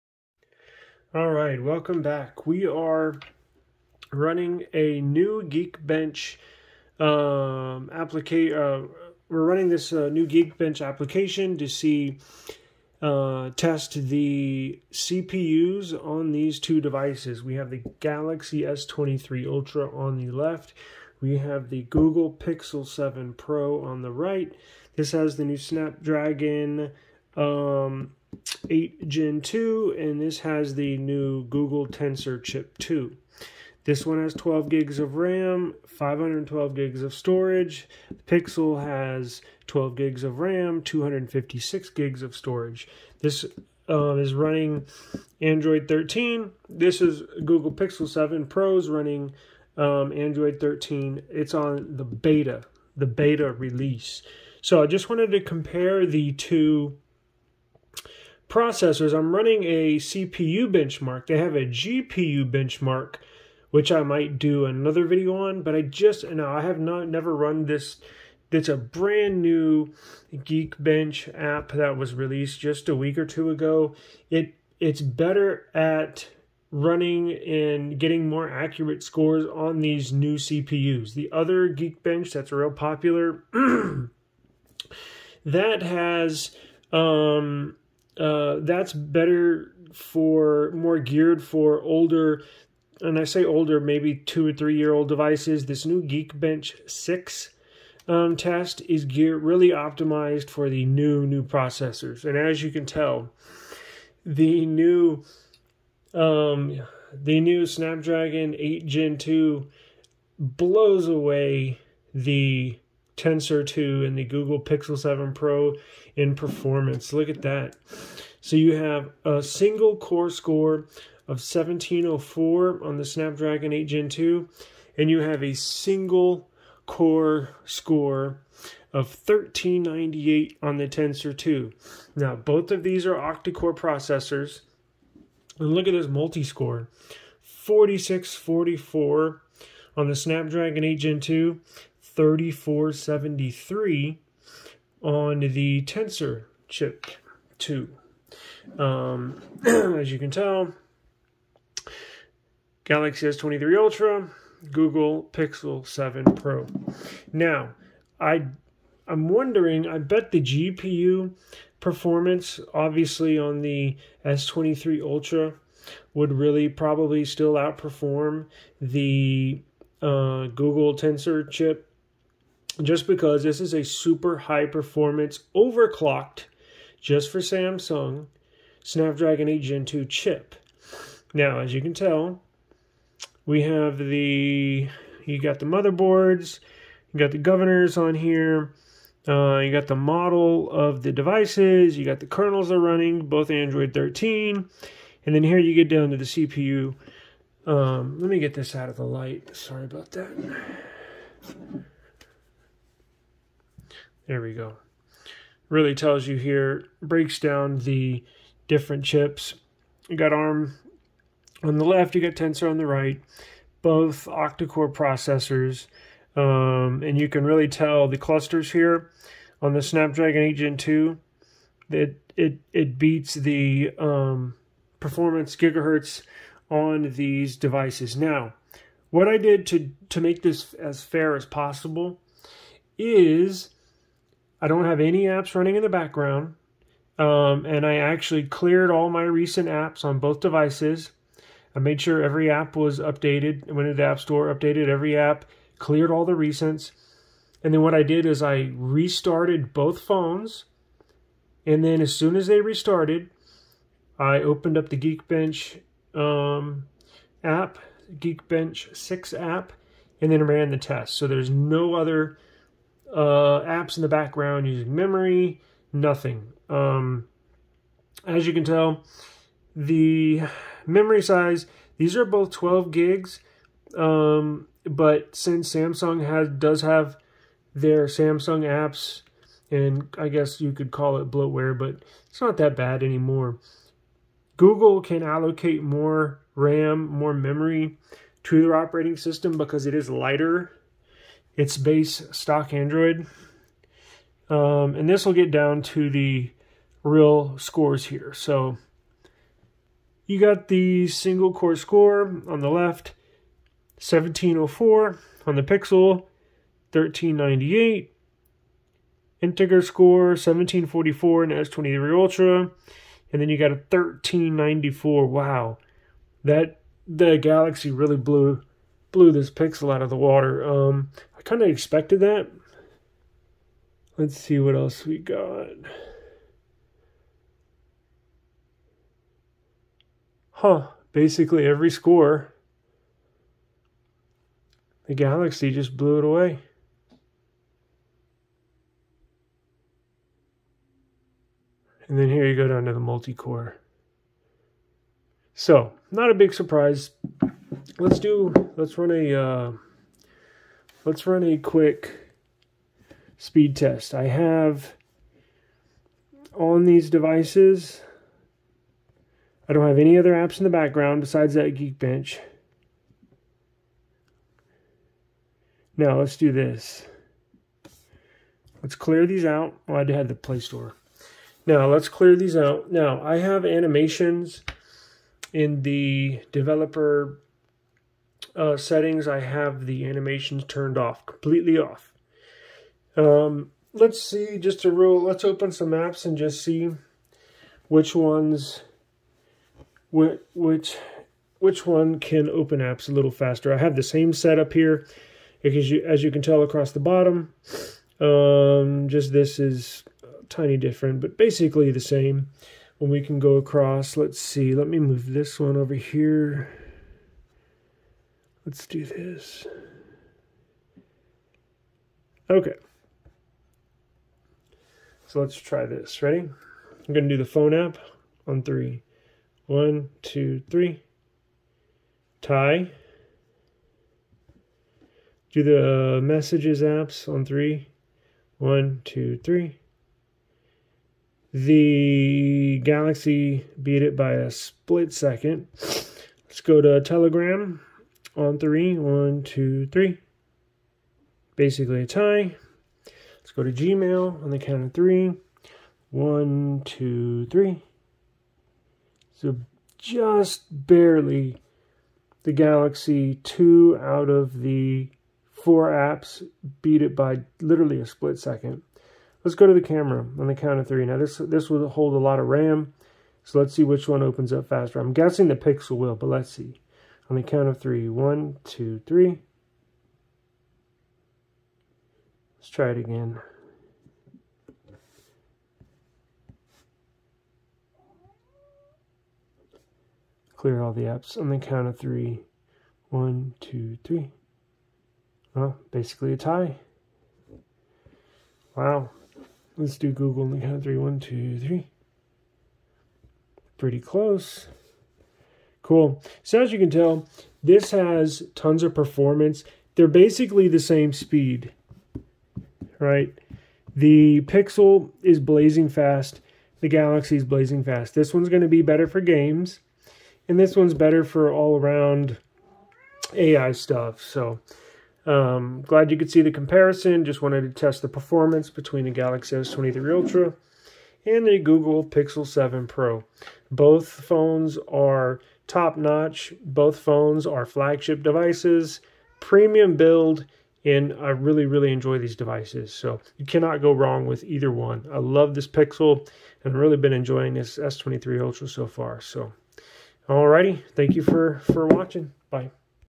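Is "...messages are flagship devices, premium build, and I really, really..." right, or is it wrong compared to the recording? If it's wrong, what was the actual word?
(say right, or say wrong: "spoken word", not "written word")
wrong: "phones", not "messages".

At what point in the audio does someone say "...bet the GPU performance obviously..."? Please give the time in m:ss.
2:39.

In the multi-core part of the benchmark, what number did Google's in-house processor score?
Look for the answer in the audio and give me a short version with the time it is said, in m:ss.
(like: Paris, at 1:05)
3473, at 2:22.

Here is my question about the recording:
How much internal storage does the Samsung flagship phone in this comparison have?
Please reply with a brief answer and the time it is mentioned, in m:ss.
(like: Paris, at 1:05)
512 GB, at 0:35.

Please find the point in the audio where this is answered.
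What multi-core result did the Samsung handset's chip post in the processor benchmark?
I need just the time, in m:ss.
2:17.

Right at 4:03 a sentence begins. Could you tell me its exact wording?
I went into the App Store, updated every app, cleared all the recents.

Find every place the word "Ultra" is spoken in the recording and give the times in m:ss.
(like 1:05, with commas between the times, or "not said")
0:19, 2:33, 2:45, 5:12, 8:40, 8:58.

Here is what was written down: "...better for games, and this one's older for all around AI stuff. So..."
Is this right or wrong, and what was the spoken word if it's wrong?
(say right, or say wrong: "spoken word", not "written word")
wrong: "better", not "older".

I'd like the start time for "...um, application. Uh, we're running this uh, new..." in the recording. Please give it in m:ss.
0:07.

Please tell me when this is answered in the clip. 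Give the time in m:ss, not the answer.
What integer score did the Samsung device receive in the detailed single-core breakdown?
5:10.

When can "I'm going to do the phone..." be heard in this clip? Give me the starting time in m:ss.
6:56.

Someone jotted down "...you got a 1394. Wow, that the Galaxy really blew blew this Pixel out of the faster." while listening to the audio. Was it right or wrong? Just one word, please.
wrong.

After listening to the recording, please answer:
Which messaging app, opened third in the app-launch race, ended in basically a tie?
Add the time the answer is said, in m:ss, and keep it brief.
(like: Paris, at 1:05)
Telegram, at 7:17.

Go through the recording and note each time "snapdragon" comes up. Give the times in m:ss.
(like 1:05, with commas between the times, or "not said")
0:25, 1:47, 2:03, 2:20, 2:58, 3:39.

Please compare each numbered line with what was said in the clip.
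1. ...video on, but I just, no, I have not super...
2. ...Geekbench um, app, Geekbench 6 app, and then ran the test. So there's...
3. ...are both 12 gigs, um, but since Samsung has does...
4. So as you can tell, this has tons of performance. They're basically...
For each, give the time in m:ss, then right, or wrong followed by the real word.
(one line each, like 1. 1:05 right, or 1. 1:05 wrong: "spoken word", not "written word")
1. 1:05 wrong: "never", not "super"
2. 4:14 right
3. 4:32 right
4. 8:16 right.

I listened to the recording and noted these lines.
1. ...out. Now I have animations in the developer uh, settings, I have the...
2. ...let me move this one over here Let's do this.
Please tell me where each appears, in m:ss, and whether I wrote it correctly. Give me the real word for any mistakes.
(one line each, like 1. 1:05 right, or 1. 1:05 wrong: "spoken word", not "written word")
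1. 6:12 right
2. 6:44 right.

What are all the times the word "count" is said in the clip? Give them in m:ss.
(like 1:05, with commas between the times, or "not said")
7:24, 7:40, 7:47, 8:01, 8:10.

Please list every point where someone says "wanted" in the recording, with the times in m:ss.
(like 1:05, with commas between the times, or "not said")
0:55, 8:37.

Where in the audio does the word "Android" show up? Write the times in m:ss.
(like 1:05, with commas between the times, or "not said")
0:45, 0:50, 3:13, 4:52.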